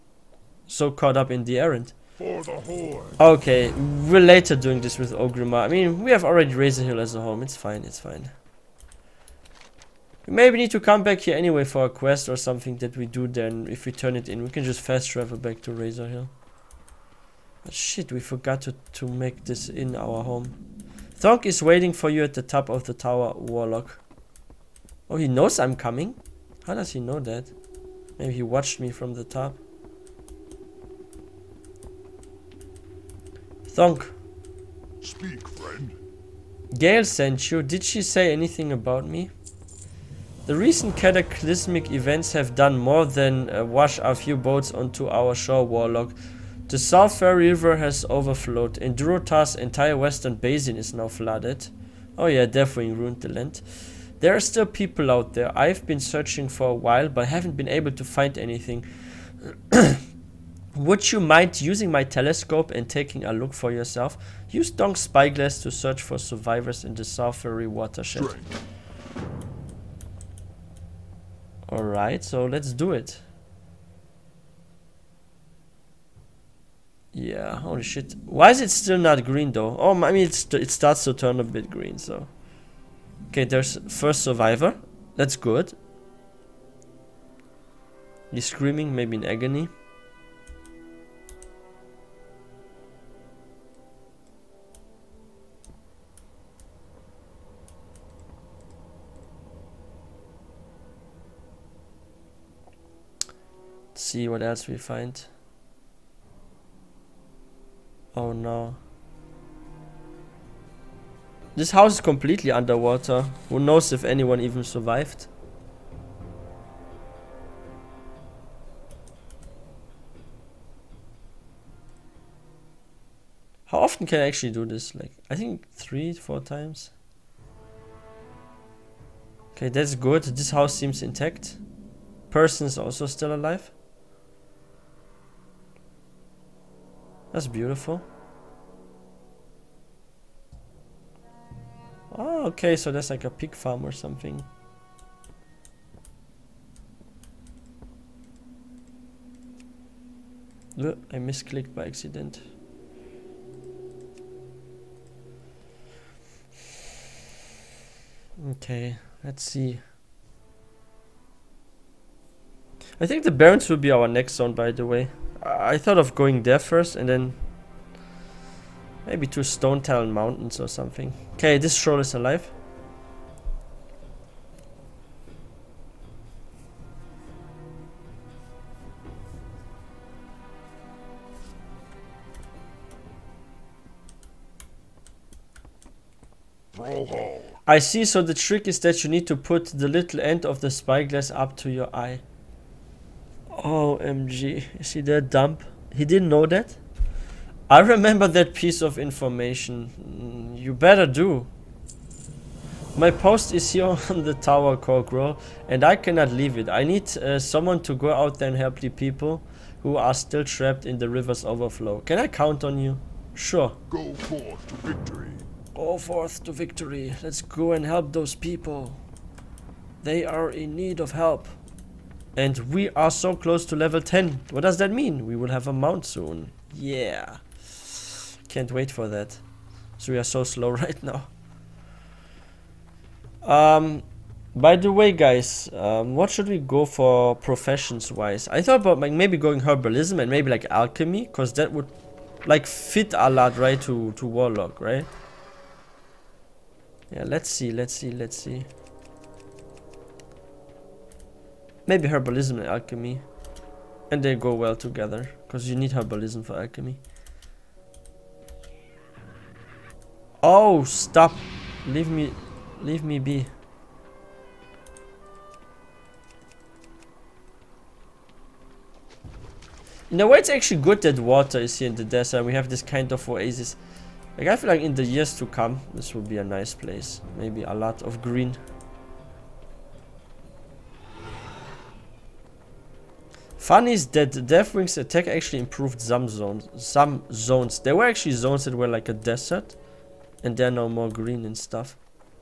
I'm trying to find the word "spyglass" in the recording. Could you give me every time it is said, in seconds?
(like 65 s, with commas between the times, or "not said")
65 s, 190 s.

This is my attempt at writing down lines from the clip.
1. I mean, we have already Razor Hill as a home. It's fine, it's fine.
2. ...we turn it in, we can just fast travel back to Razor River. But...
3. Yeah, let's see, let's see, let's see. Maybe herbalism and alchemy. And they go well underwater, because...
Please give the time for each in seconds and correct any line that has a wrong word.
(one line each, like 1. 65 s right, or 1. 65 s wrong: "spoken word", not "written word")
1. 5 s right
2. 13 s wrong: "Hill", not "River"
3. 247 s wrong: "together", not "underwater".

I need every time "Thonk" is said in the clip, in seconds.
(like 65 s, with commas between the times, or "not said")
21 s, 64 s.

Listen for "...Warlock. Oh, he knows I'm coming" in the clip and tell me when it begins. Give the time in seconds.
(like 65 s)
23 s.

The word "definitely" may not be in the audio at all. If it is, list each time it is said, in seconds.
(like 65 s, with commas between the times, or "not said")
52 s.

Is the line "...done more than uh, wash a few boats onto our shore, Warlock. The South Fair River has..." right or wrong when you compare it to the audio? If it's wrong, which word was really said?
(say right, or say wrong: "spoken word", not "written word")
right.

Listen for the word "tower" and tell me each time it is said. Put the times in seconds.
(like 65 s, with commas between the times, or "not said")
22 s, 204 s.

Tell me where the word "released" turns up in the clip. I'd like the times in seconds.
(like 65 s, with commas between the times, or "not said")
not said.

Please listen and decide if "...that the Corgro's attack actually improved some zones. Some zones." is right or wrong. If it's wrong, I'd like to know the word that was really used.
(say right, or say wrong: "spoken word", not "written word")
wrong: "Deathwing", not "Corgro".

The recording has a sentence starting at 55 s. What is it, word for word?
I've been searching for a while, but haven't been able to find anything.